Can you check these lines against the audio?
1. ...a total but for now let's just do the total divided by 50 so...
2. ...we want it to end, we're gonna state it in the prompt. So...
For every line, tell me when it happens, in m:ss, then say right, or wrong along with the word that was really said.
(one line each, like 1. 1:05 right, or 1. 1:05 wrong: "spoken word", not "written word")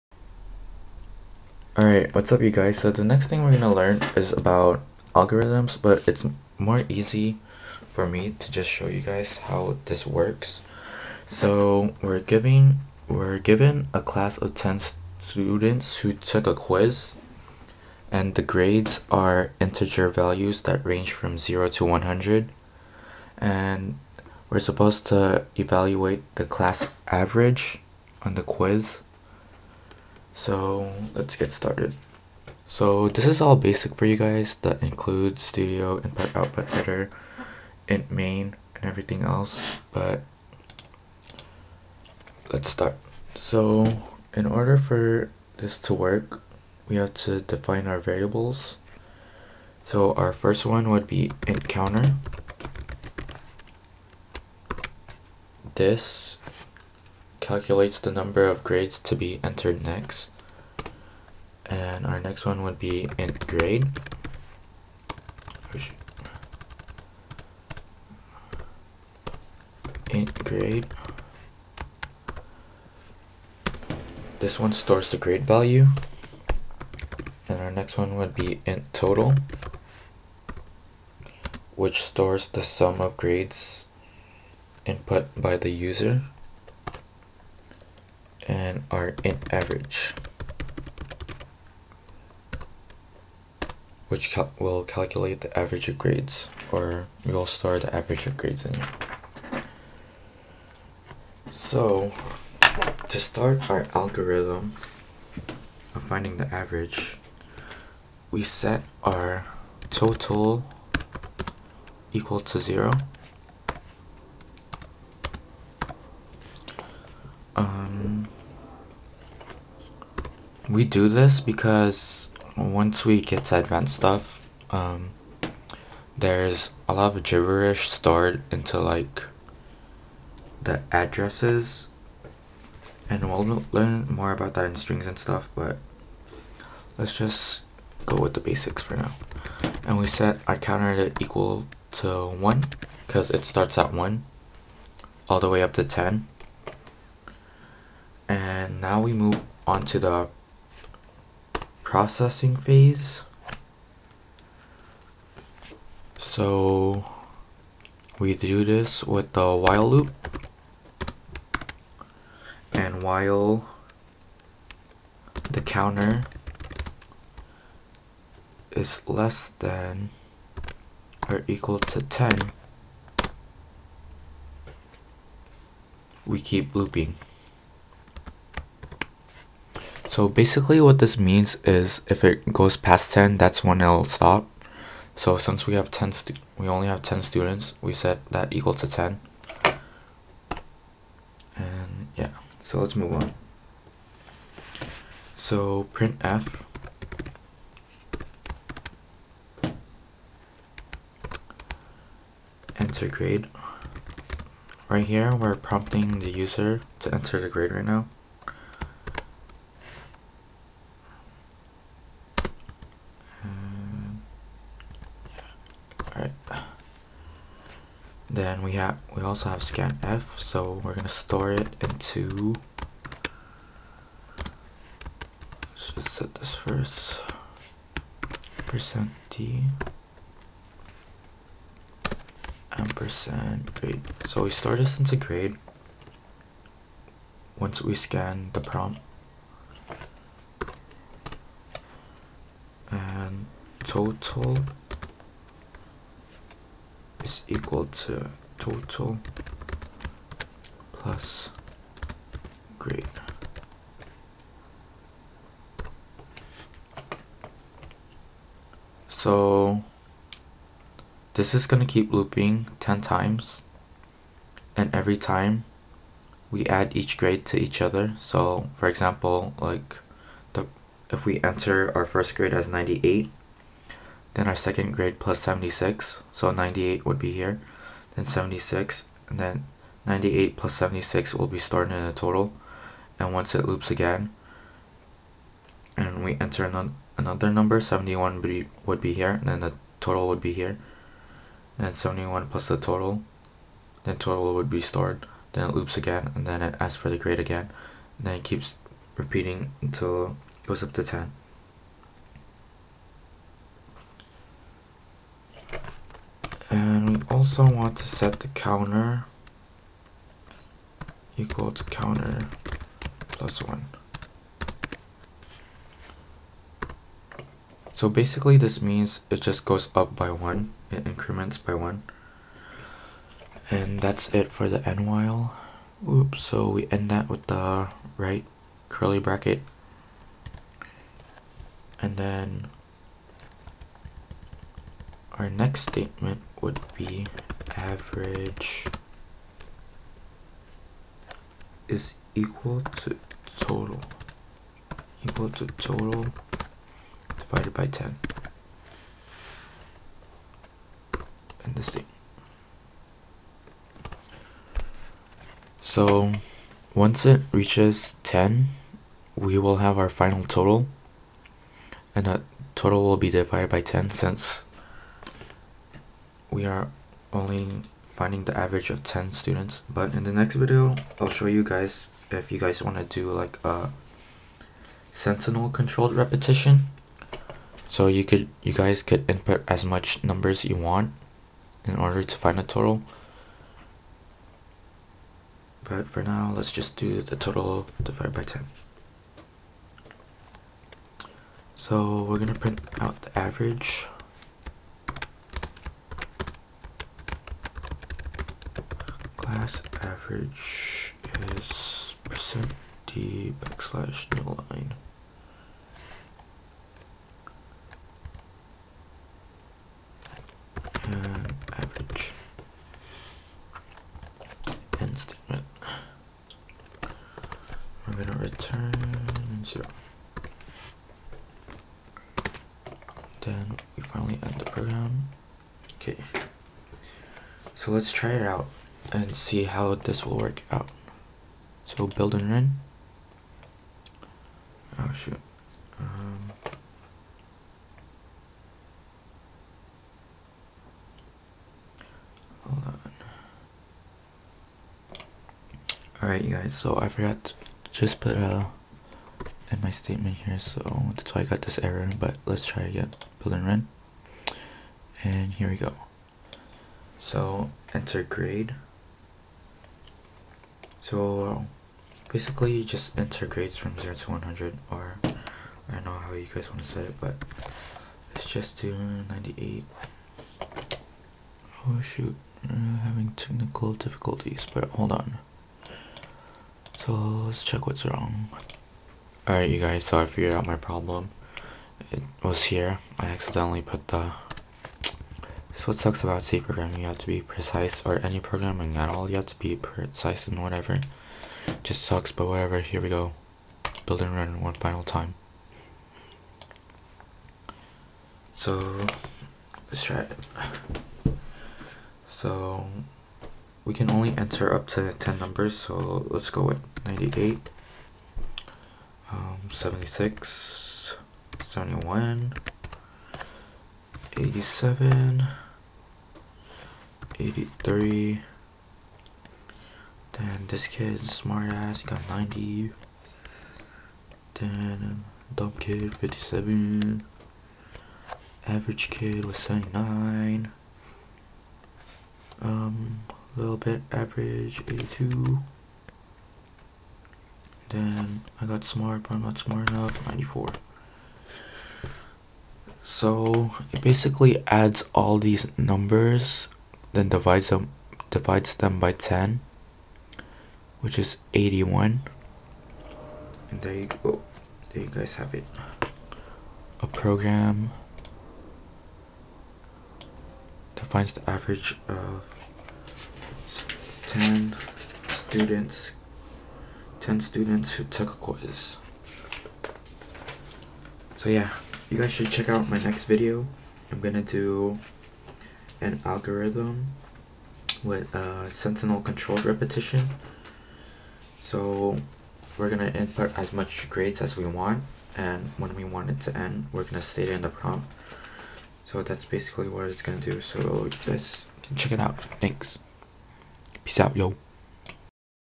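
1. 6:22 wrong: "10", not "50"
2. 9:45 right.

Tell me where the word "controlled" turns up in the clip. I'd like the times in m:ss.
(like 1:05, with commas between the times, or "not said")
6:15, 9:39.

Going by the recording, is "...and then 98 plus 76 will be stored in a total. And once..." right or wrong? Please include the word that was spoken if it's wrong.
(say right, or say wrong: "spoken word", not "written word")
right.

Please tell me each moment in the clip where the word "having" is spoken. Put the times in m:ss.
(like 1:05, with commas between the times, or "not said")
7:52.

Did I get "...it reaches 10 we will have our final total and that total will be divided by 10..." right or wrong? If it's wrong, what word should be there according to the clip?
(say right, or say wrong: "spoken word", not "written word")
right.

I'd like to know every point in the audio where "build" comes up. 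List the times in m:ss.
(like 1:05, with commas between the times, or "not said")
7:12, 7:33, 8:14.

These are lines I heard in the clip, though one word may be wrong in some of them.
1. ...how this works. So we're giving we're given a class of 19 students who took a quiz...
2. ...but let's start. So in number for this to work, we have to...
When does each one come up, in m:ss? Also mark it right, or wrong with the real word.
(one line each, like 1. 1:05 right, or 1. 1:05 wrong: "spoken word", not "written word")
1. 0:09 wrong: "10", not "19"
2. 0:39 wrong: "order", not "number".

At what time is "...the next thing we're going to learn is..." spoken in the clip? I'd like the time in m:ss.
0:02.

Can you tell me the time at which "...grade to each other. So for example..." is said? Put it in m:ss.
4:27.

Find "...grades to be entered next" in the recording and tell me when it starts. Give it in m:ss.
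0:58.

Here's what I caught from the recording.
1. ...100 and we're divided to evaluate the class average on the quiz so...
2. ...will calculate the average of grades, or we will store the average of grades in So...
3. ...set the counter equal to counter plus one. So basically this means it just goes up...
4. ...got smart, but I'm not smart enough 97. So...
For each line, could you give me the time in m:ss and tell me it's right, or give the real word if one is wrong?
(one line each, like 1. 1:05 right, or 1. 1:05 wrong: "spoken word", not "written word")
1. 0:21 wrong: "supposed", not "divided"
2. 1:34 right
3. 5:08 right
4. 8:58 wrong: "94", not "97".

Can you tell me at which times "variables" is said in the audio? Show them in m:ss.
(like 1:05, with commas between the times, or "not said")
0:47.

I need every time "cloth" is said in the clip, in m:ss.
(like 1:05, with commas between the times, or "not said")
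not said.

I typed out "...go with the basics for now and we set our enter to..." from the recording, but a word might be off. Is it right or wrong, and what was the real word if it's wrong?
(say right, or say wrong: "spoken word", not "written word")
wrong: "counter", not "enter".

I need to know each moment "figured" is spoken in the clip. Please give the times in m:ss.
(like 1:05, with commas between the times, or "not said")
8:00.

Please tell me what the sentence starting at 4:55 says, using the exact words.
Then it loops again, and then it asks for the grade again.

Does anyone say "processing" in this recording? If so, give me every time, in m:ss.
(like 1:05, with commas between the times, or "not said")
2:31.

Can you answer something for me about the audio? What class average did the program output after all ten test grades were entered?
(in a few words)
81.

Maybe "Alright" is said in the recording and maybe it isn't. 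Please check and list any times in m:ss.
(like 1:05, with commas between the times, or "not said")
0:01, 7:26, 7:59.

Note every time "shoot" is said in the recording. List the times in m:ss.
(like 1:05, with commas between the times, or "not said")
7:15, 7:52.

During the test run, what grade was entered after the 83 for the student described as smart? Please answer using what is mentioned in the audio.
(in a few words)
90.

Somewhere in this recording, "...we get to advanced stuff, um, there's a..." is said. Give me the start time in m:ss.
2:03.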